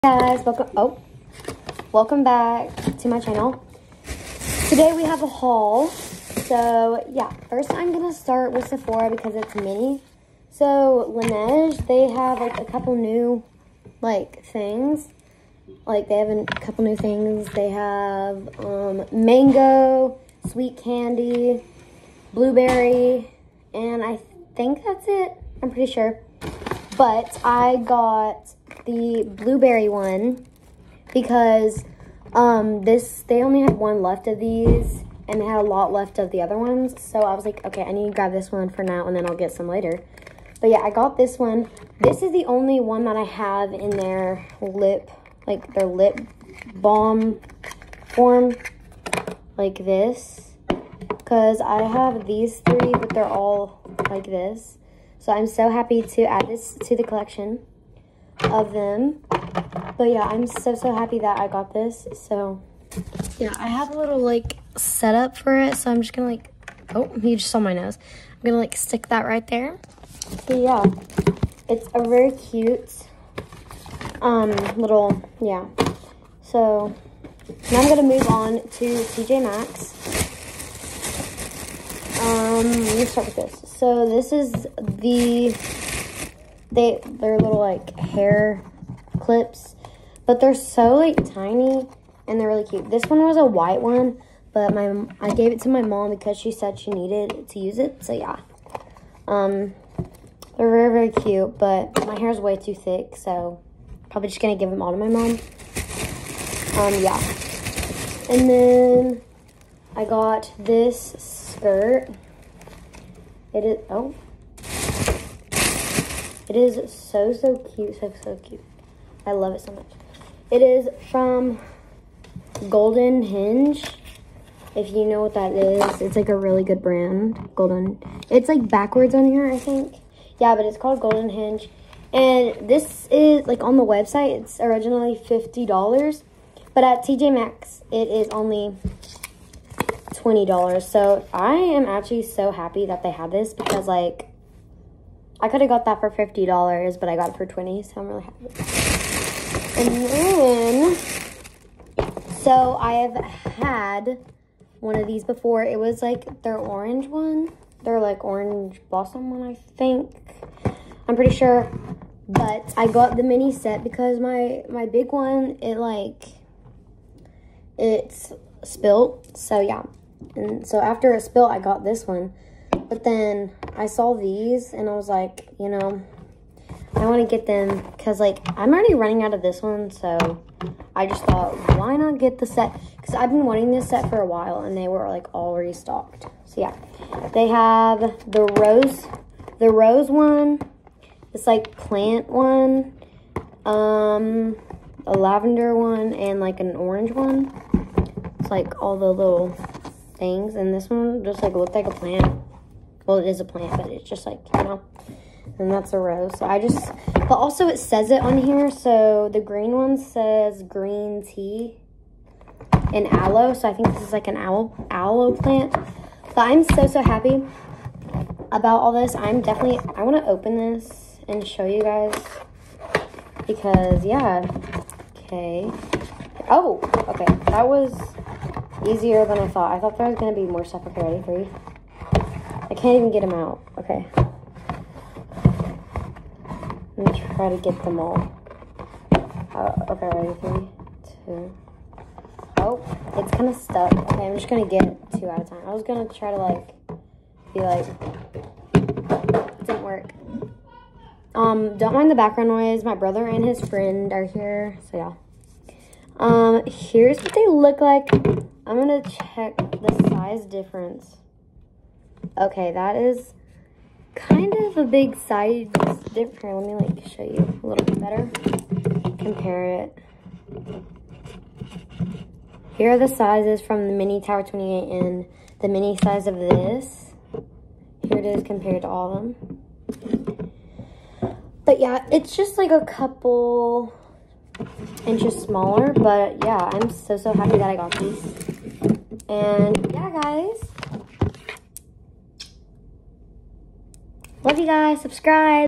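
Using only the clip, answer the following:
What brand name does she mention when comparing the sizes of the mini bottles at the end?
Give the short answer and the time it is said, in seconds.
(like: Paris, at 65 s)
Tower 28, at 274 s.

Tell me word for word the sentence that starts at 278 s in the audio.
Here it is compared to all of them.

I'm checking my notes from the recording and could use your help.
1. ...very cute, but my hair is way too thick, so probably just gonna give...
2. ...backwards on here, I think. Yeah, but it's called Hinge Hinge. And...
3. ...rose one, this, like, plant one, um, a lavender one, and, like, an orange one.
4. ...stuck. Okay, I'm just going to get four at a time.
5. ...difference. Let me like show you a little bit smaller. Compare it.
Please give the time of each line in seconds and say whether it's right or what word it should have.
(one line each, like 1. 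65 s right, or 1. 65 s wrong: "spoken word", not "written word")
1. 100 s right
2. 128 s wrong: "Golden", not "Hinge"
3. 189 s right
4. 243 s wrong: "two", not "four"
5. 266 s wrong: "better", not "smaller".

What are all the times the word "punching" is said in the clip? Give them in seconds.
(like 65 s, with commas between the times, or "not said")
not said.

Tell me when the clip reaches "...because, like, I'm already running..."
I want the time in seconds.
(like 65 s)
177 s.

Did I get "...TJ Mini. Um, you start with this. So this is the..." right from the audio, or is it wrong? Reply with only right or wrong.
wrong.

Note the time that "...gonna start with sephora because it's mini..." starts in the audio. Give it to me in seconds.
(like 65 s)
7 s.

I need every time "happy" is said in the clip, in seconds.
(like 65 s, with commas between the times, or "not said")
55 s, 60 s, 142 s, 148 s, 217 s, 287 s.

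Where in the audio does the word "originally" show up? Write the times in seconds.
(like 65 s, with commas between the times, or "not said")
134 s.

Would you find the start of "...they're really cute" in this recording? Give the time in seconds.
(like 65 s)
92 s.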